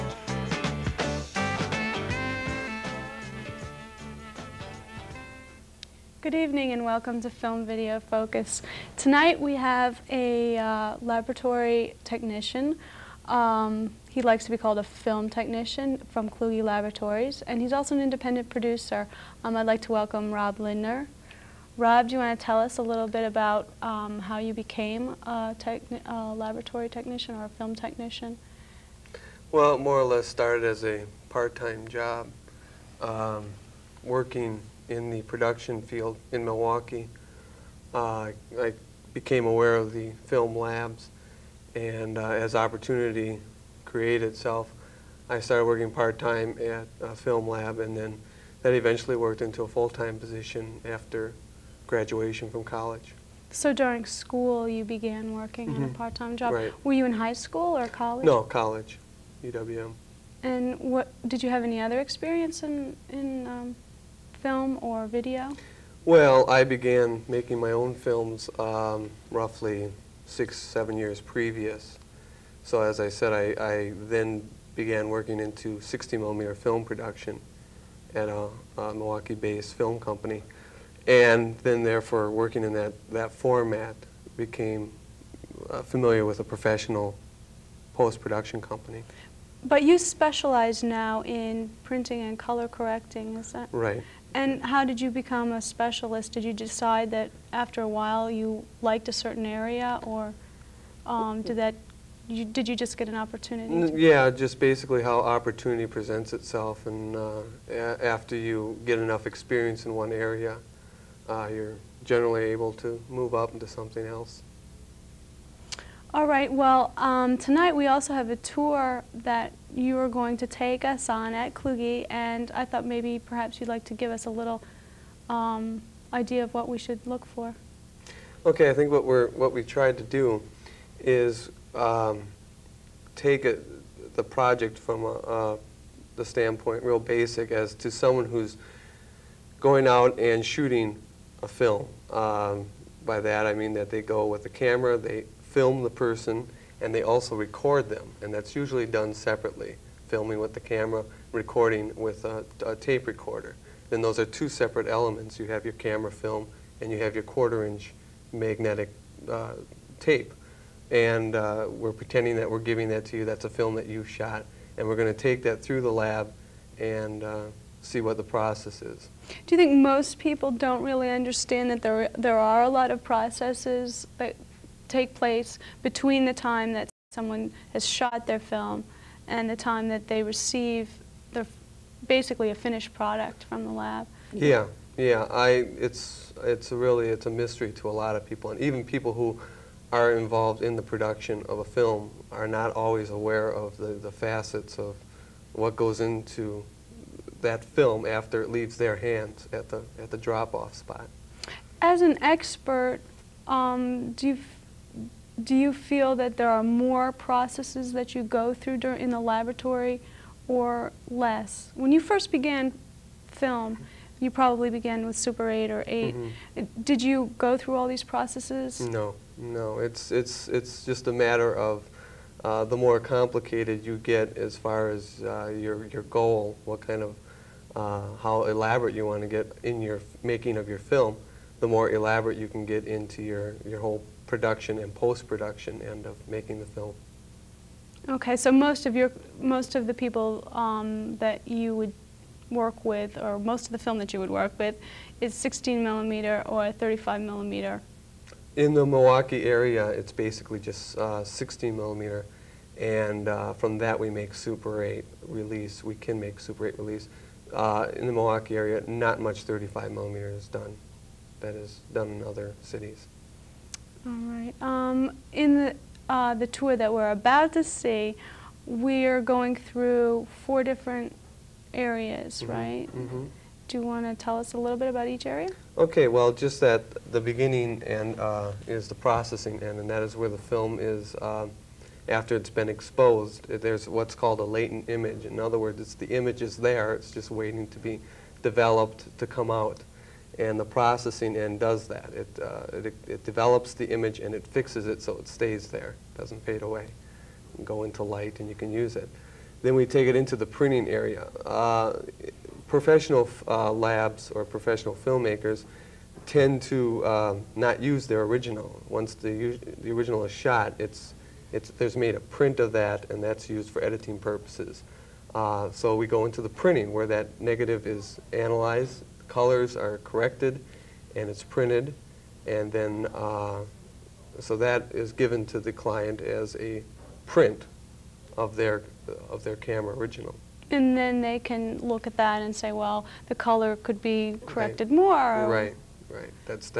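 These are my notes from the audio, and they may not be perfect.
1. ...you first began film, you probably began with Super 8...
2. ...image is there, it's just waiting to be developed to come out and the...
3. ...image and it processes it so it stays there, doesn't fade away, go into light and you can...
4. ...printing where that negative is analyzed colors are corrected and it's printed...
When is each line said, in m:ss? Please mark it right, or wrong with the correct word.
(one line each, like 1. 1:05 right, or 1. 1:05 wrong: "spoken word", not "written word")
1. 3:31 right
2. 4:46 right
3. 4:53 wrong: "fixes", not "processes"
4. 5:16 right.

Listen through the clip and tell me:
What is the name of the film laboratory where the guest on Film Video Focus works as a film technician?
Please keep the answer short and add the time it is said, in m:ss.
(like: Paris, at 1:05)
Kluge Laboratories, at 0:16.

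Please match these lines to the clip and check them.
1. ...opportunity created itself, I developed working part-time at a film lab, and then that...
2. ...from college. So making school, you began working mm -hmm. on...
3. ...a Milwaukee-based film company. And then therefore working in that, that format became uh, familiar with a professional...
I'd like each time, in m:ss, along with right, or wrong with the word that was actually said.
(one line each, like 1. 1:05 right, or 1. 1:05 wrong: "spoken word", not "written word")
1. 0:42 wrong: "started", not "developed"
2. 0:52 wrong: "during", not "making"
3. 1:18 right.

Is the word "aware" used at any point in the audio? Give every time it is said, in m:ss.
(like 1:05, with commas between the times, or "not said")
0:39, 3:13.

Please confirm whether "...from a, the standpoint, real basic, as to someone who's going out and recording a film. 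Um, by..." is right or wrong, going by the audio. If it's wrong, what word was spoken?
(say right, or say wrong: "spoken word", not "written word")
wrong: "shooting", not "recording".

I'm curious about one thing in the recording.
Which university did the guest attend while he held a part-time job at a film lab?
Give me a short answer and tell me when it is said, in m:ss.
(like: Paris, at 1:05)
UWM, at 0:59.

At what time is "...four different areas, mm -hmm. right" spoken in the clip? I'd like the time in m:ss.
4:30.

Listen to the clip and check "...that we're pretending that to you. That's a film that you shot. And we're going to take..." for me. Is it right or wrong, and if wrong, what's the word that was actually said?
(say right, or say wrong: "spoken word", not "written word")
wrong: "giving", not "pretending".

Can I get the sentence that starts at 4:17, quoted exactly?
Uh, in the Milwaukee area, not much 35 millimeter is done.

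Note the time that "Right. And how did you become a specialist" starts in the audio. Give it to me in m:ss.
1:33.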